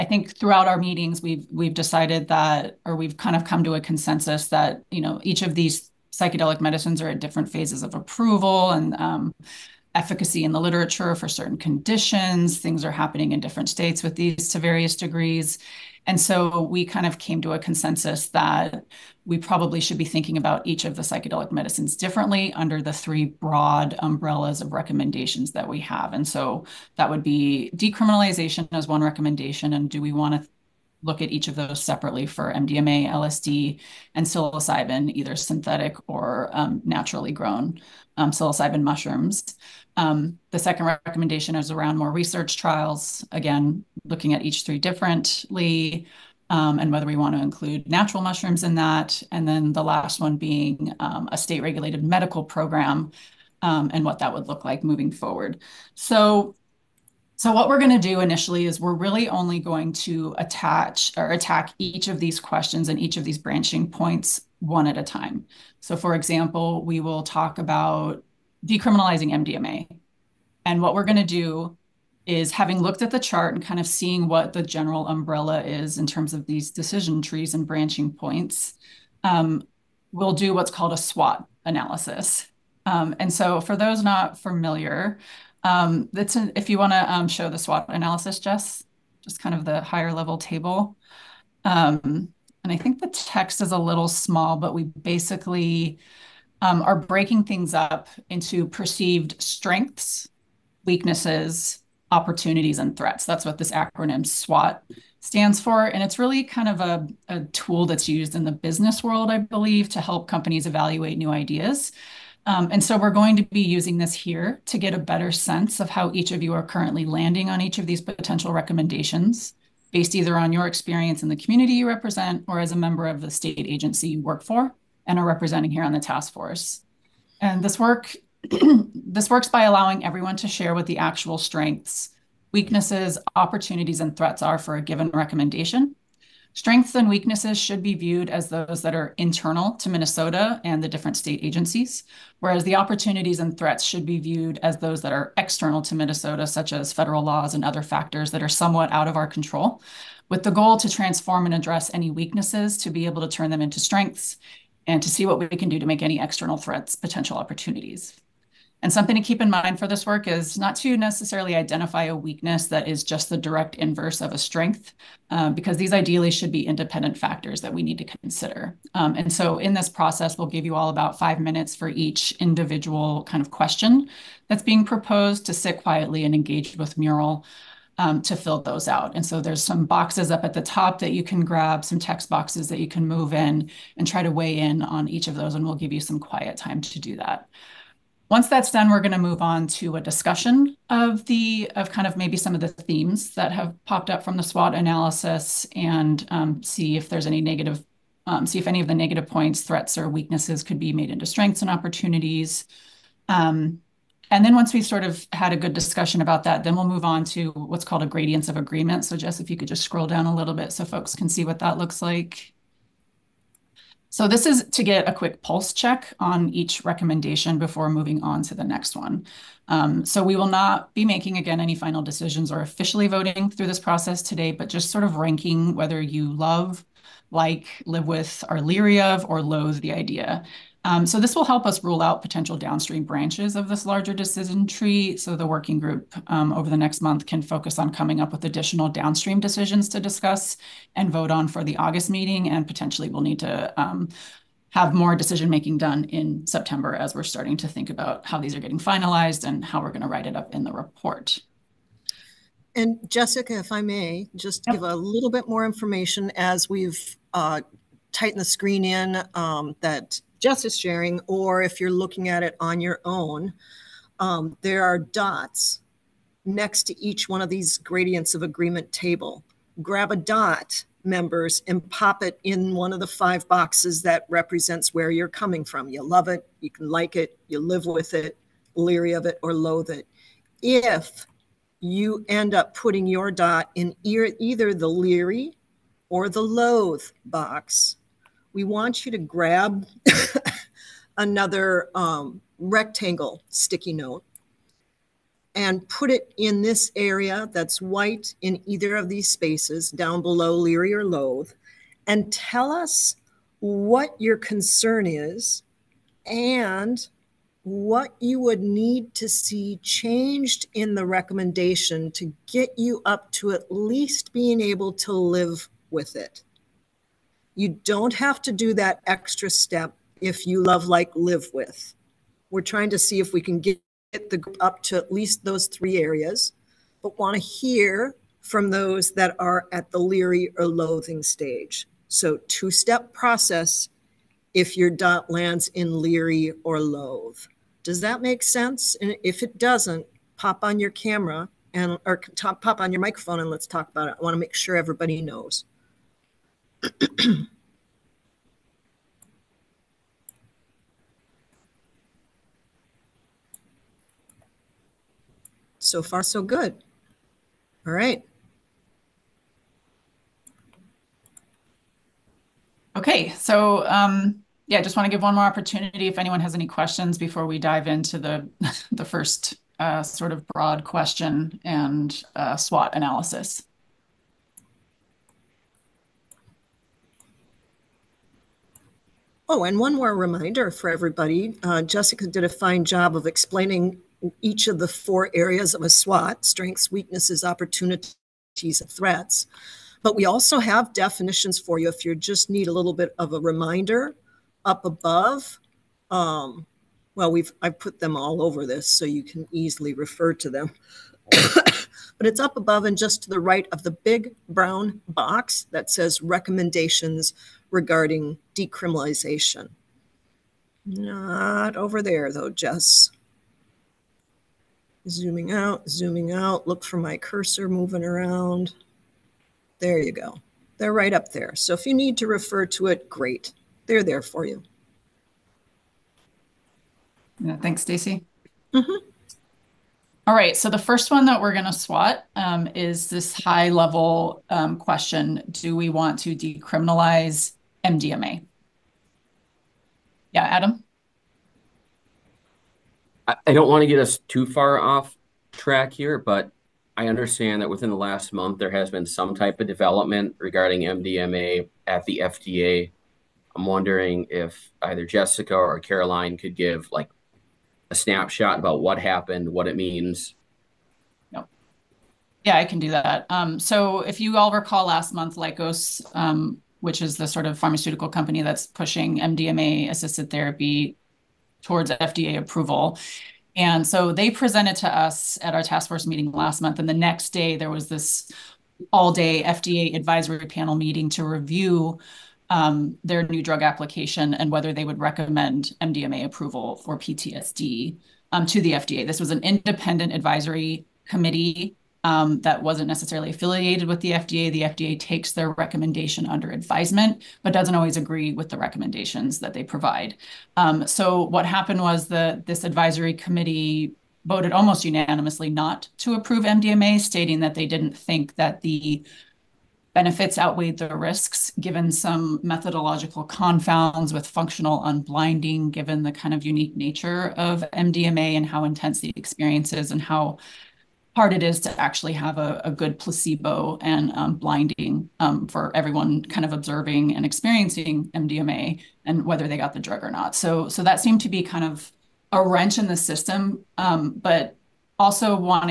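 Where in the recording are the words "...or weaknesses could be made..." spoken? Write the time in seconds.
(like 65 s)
199 s.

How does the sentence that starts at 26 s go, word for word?
And so that would be decriminalization as one recommendation.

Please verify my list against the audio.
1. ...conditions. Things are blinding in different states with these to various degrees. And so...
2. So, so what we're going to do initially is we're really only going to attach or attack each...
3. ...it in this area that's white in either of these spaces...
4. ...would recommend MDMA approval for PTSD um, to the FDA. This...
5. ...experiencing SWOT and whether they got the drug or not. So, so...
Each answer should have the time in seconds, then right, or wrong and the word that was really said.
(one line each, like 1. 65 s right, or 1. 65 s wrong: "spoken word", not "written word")
1. 11 s wrong: "happening", not "blinding"
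2. 55 s right
3. 296 s right
4. 484 s right
5. 527 s wrong: "MDMA", not "SWOT".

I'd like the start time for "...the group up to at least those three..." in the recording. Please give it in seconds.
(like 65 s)
324 s.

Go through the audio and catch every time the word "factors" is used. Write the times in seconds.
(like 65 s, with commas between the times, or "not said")
147 s, 167 s.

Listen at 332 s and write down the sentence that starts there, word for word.
So two step process if your dot lands in leery or loathe.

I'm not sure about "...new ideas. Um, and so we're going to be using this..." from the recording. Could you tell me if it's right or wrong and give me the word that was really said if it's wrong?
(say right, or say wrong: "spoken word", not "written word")
right.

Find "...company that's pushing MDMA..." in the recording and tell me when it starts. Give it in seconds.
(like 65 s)
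468 s.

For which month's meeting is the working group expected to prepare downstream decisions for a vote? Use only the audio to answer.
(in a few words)
August.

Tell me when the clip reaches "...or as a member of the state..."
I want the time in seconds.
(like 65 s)
122 s.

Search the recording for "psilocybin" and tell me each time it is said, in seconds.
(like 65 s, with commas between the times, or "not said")
34 s, 38 s.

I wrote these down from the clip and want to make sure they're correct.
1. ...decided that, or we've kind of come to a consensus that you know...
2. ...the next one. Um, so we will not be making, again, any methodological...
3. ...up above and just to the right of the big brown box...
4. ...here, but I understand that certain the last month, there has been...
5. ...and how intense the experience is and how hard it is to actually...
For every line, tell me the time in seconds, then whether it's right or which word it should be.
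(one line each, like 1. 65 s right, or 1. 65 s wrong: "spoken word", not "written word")
1. 1 s right
2. 218 s wrong: "final", not "methodological"
3. 402 s right
4. 445 s wrong: "within", not "certain"
5. 518 s right.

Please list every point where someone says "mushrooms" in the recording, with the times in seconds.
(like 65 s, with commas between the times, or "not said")
38 s, 48 s.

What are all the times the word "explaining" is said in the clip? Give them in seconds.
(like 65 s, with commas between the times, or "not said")
383 s.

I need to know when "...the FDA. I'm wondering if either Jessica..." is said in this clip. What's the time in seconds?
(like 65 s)
452 s.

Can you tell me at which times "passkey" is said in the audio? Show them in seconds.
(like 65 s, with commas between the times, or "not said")
not said.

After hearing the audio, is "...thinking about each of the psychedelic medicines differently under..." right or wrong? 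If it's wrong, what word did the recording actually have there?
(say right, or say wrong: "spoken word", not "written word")
right.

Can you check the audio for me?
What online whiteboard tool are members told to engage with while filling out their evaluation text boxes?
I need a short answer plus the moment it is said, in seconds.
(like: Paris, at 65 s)
Mural, at 176 s.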